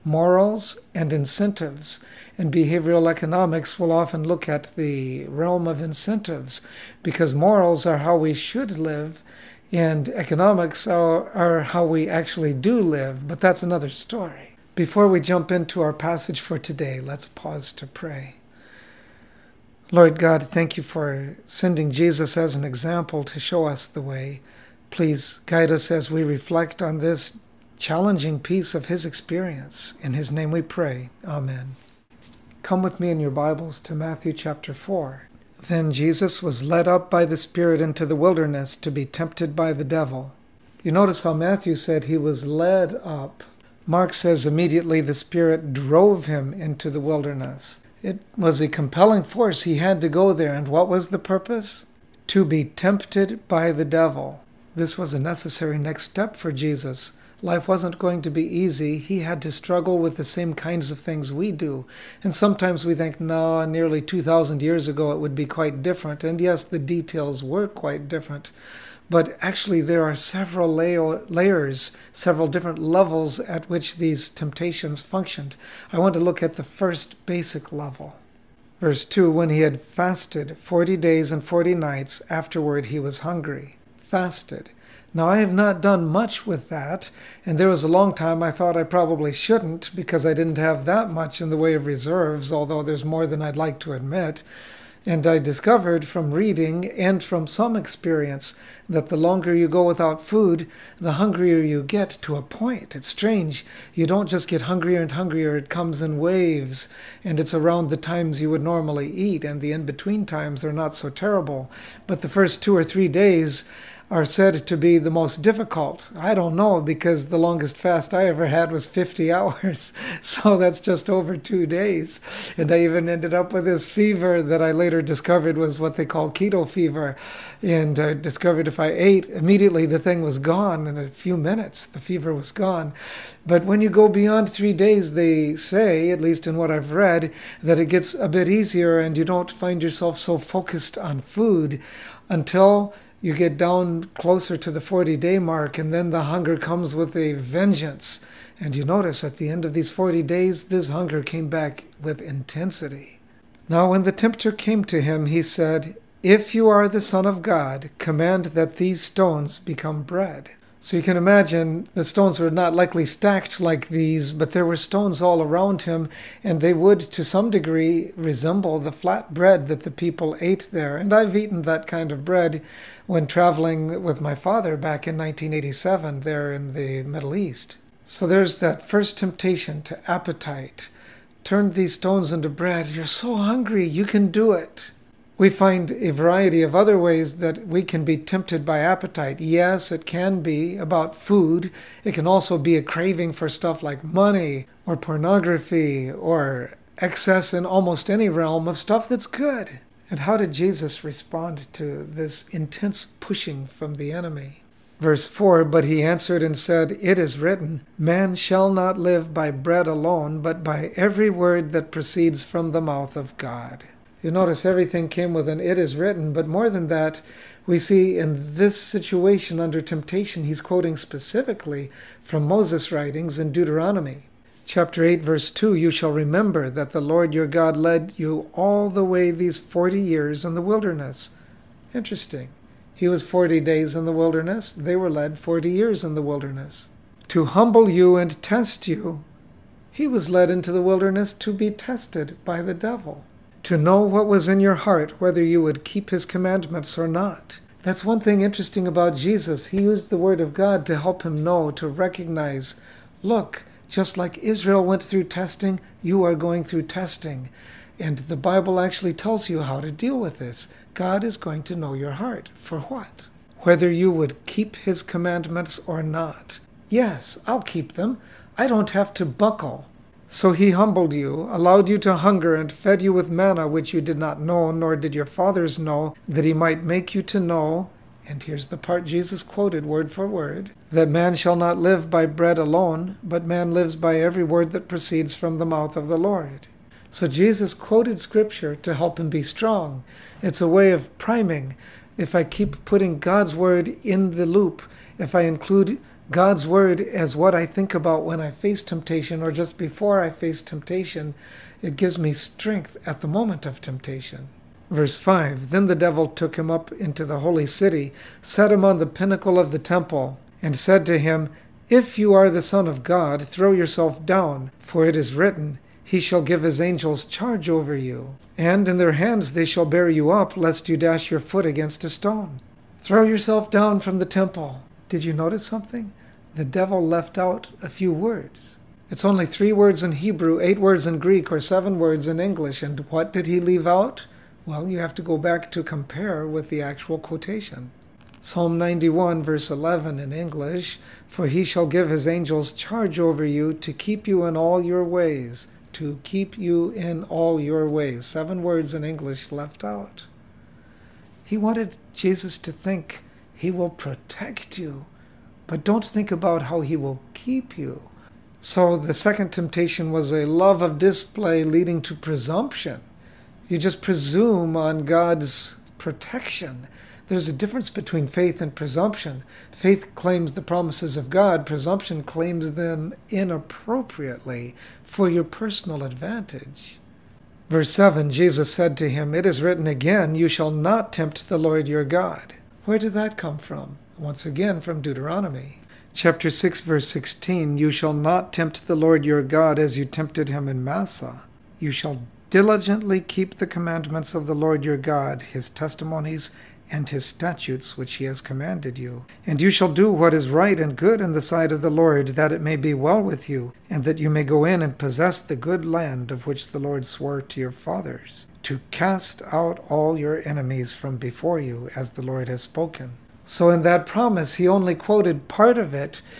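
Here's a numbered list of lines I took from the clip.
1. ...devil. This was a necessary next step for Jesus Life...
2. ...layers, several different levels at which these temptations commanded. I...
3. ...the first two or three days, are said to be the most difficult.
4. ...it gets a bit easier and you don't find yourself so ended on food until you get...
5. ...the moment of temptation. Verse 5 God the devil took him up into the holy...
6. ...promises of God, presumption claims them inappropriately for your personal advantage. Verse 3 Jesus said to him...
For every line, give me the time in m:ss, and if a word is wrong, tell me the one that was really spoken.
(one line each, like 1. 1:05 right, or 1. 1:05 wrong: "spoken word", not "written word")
1. 0:53 right
2. 1:10 wrong: "functioned", not "commanded"
3. 1:52 right
4. 2:17 wrong: "focused", not "ended"
5. 5:03 wrong: "Then", not "God"
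6. 6:10 wrong: "7", not "3".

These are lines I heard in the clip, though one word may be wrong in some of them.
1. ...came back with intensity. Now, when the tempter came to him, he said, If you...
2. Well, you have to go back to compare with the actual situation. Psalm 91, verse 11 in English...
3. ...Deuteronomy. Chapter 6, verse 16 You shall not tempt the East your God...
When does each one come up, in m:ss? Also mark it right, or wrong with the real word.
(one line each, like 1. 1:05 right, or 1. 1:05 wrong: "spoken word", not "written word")
1. 2:31 right
2. 5:34 wrong: "quotation", not "situation"
3. 6:25 wrong: "Lord", not "East".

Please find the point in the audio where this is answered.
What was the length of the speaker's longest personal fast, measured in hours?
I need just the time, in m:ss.
1:58.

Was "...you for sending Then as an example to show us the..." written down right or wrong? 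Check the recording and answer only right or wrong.
wrong.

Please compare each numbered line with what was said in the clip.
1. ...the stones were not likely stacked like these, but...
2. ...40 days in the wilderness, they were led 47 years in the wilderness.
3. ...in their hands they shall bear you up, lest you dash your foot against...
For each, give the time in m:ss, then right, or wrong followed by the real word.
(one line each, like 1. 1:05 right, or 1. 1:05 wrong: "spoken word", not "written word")
1. 2:41 right
2. 3:53 wrong: "40", not "47"
3. 5:18 right.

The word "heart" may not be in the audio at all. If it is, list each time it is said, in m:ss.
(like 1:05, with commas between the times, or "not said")
4:04, 4:22.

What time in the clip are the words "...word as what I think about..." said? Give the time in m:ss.
4:56.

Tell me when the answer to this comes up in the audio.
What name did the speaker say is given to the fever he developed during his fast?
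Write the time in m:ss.
2:06.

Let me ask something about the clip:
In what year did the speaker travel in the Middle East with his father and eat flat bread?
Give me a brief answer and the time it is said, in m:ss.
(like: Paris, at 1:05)
1987, at 2:55.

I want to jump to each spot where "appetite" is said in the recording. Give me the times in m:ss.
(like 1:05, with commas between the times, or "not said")
3:00, 3:08.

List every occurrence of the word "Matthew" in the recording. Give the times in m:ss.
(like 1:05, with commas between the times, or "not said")
0:33, 0:41.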